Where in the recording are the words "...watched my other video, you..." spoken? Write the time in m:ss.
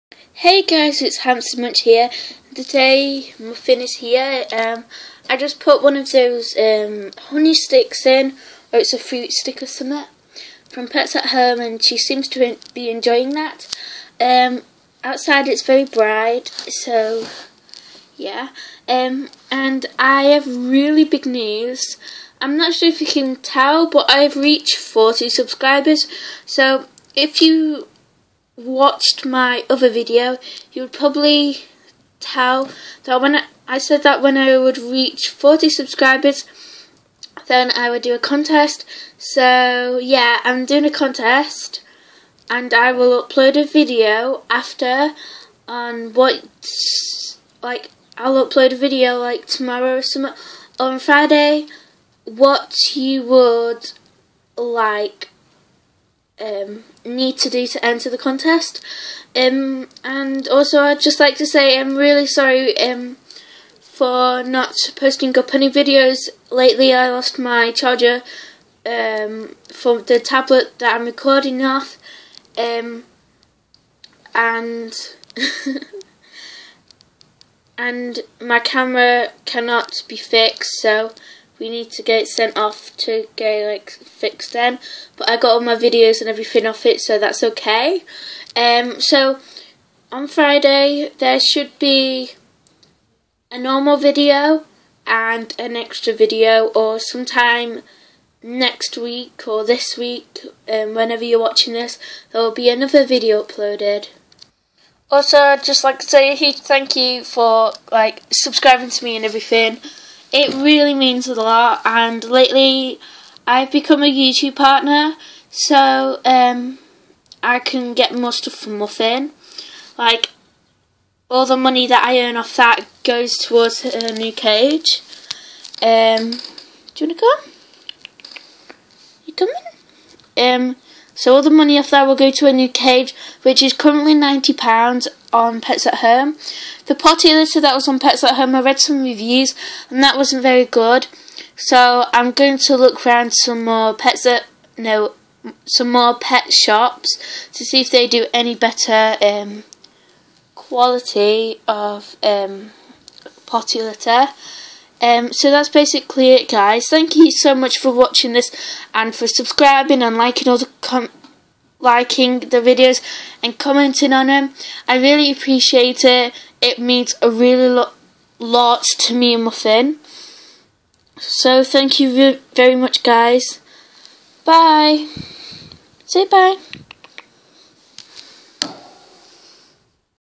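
0:28.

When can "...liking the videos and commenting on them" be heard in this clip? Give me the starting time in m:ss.
2:41.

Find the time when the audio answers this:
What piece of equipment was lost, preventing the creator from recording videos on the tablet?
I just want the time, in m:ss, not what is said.
1:07.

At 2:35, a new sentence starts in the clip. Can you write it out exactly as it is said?
Um, so that's basically it, guys.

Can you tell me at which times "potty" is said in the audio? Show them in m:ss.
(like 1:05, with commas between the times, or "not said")
2:16, 2:33.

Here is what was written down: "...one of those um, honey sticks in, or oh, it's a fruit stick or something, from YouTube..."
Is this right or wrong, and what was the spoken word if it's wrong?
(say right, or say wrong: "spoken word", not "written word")
wrong: "Pets", not "YouTube".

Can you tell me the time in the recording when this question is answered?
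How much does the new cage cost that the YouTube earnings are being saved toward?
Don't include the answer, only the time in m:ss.
2:14.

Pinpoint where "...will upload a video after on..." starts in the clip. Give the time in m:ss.
0:42.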